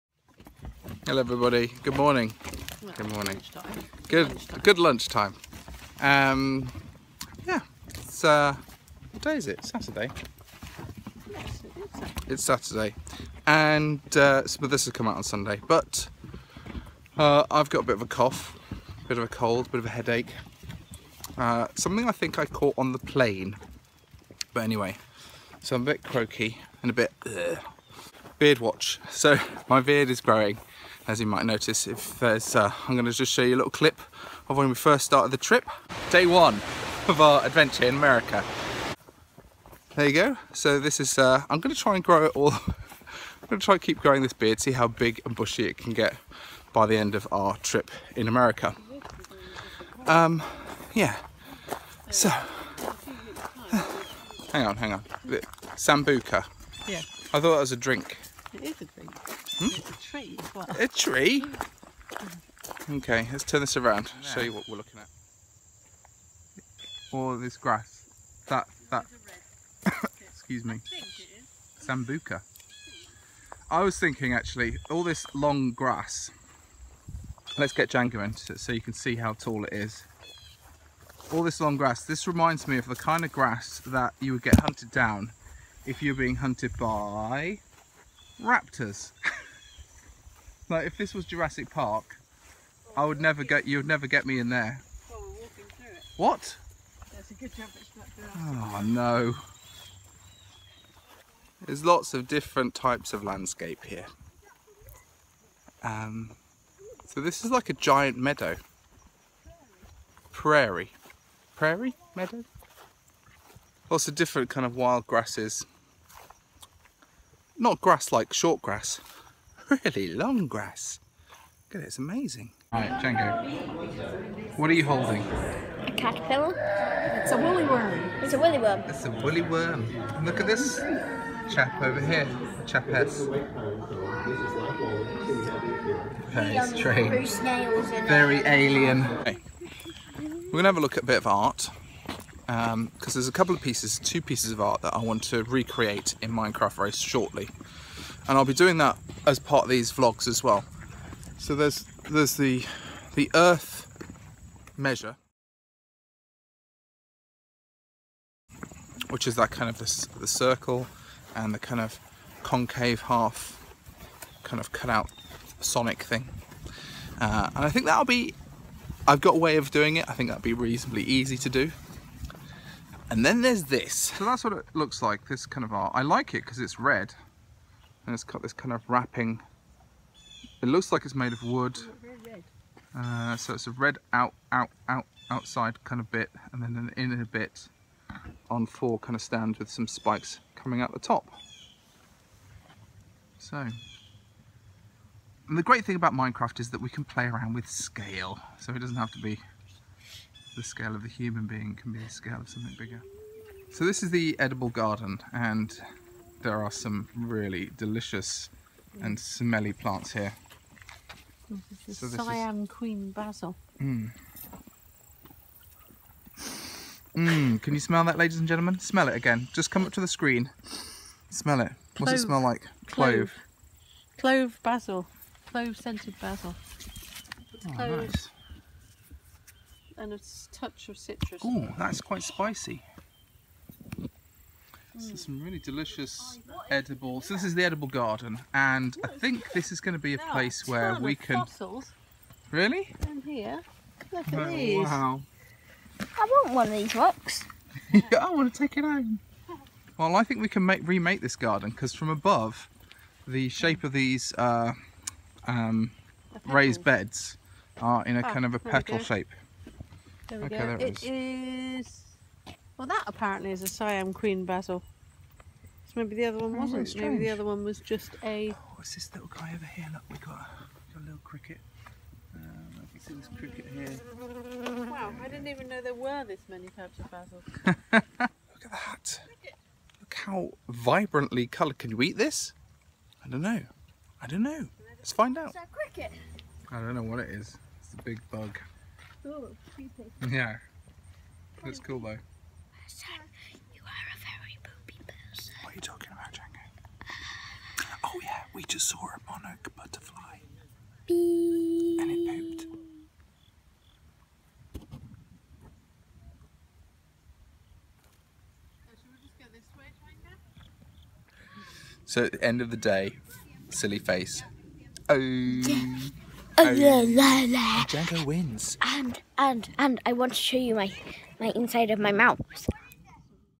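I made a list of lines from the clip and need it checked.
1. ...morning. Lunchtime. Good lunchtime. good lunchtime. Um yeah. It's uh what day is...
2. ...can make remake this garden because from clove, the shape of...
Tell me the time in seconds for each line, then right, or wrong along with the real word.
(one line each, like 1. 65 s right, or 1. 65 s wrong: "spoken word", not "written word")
1. 3 s right
2. 250 s wrong: "above", not "clove".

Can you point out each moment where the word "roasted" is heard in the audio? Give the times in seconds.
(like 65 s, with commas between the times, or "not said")
not said.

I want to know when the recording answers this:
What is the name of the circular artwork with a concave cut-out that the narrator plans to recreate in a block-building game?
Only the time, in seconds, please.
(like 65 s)
153 s.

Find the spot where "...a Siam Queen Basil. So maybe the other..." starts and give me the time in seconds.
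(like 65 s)
263 s.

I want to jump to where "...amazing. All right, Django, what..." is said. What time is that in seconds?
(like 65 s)
121 s.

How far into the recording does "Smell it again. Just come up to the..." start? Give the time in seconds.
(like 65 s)
218 s.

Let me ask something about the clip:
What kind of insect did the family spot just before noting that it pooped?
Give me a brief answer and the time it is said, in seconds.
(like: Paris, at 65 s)
Monarch butterfly, at 299 s.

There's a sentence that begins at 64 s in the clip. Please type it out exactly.
show you what we're looking at.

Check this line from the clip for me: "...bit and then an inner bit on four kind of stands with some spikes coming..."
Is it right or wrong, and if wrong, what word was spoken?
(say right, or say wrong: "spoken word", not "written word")
right.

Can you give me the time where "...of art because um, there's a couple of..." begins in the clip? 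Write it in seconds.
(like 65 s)
141 s.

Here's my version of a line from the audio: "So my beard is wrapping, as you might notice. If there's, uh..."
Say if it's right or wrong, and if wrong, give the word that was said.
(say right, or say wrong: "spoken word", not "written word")
wrong: "growing", not "wrapping".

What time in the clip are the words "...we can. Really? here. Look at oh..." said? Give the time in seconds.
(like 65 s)
240 s.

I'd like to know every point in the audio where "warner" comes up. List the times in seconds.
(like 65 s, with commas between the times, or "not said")
not said.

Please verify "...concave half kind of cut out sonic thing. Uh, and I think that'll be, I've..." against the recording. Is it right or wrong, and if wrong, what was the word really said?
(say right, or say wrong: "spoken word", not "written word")
right.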